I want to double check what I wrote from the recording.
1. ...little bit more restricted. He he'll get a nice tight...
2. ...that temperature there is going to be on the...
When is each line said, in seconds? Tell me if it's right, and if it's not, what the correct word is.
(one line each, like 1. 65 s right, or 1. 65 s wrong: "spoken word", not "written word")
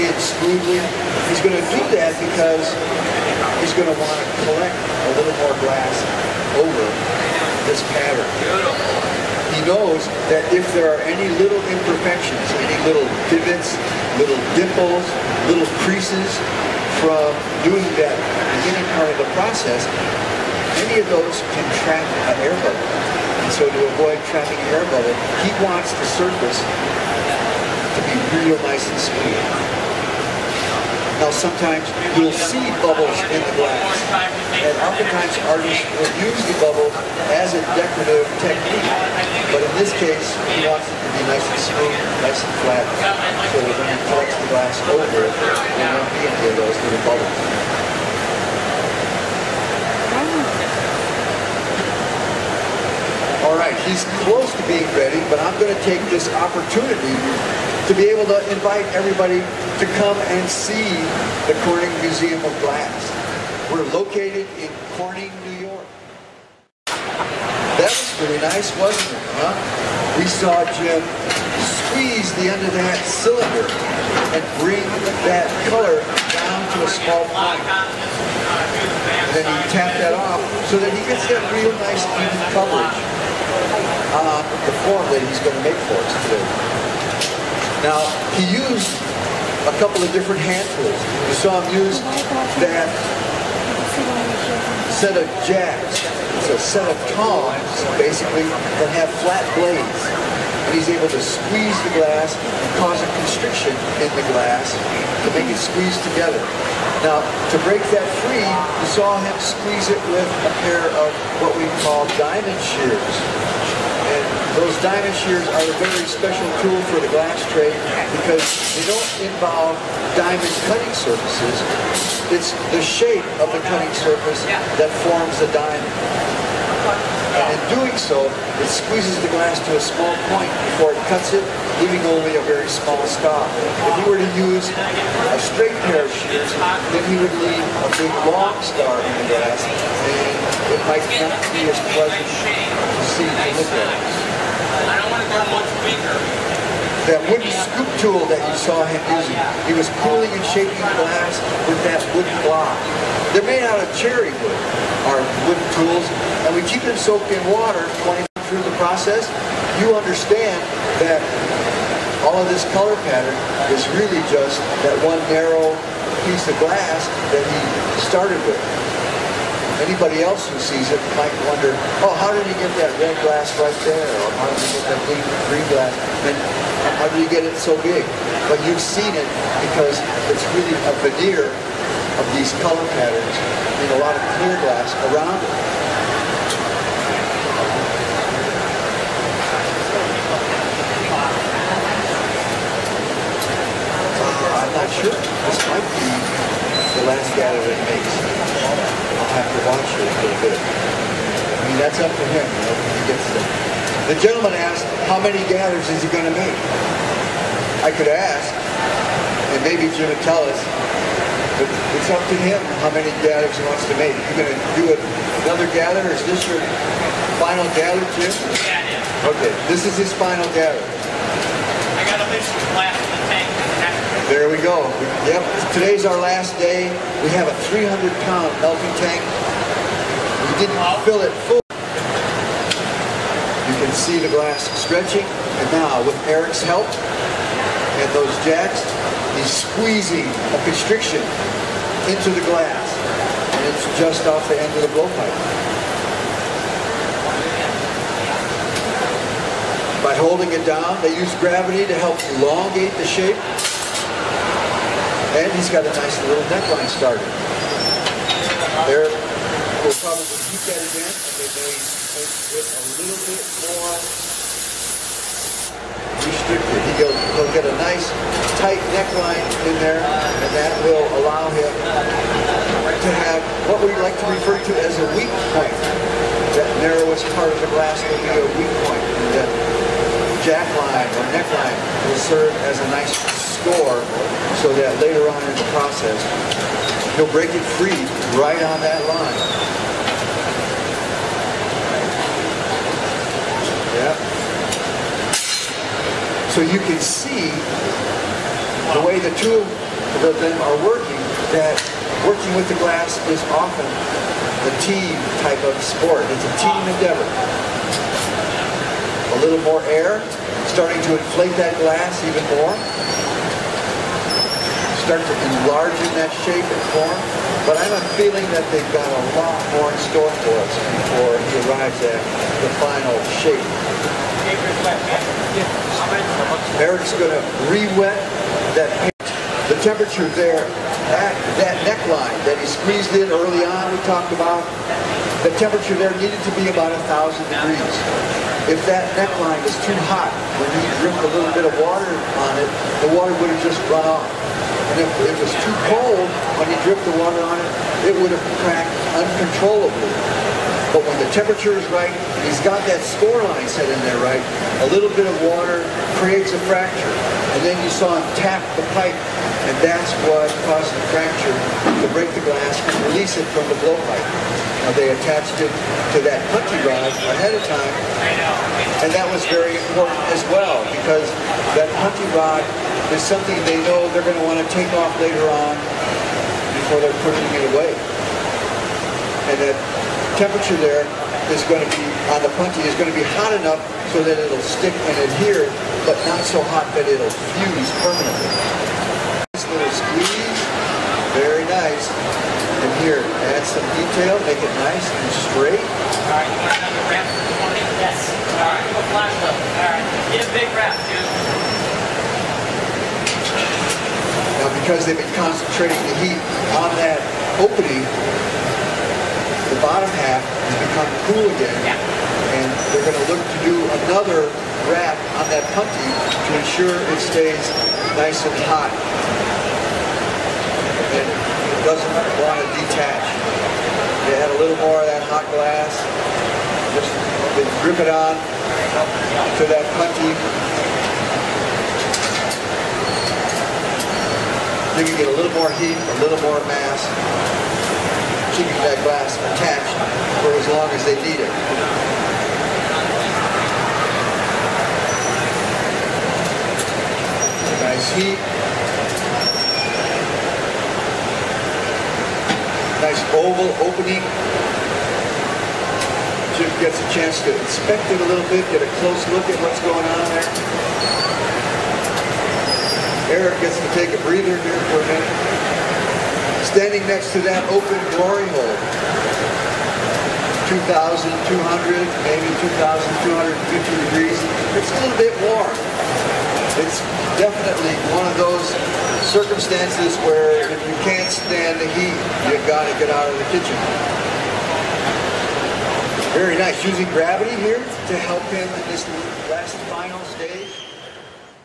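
1. 262 s right
2. 379 s right.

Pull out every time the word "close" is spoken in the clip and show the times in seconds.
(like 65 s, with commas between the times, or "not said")
54 s, 459 s.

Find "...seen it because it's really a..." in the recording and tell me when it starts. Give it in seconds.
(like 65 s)
178 s.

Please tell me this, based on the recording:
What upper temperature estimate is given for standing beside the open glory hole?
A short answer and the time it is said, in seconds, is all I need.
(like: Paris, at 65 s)
2,250 degrees, at 472 s.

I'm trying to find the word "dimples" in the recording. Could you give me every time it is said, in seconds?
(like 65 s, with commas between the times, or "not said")
14 s.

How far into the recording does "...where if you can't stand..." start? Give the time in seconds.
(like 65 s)
480 s.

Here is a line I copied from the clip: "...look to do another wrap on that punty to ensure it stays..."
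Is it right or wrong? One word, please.
right.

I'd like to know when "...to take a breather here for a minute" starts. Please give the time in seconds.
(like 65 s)
463 s.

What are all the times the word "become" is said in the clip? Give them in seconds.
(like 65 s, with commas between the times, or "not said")
410 s.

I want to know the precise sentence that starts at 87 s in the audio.
Now, he used a couple of different hand tools.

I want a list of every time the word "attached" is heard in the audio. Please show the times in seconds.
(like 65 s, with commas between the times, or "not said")
365 s, 439 s.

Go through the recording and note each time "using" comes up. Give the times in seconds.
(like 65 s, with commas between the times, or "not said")
149 s, 486 s.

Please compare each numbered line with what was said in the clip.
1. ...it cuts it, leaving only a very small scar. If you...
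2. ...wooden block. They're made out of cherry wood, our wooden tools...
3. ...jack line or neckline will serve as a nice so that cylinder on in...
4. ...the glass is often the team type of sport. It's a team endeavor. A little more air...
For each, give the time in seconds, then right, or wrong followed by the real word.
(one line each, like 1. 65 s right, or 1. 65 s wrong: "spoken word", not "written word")
1. 130 s right
2. 152 s right
3. 280 s wrong: "later", not "cylinder"
4. 302 s right.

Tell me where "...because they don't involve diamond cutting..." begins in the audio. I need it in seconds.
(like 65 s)
118 s.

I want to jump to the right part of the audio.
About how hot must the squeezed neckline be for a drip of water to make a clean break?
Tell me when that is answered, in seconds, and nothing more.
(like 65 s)
337 s.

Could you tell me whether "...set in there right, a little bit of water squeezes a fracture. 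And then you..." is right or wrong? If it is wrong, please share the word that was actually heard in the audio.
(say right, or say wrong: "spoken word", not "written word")
wrong: "creates", not "squeezes".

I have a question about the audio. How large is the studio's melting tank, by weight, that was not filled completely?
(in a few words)
300 pounds.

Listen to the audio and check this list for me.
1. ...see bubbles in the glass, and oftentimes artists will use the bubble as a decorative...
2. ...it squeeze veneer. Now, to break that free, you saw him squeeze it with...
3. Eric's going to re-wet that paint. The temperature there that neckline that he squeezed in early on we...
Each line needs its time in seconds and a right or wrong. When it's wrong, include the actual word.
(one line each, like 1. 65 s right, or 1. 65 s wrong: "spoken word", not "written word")
1. 32 s right
2. 105 s wrong: "together", not "veneer"
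3. 326 s right.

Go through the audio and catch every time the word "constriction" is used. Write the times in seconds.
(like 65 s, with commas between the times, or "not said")
103 s, 240 s.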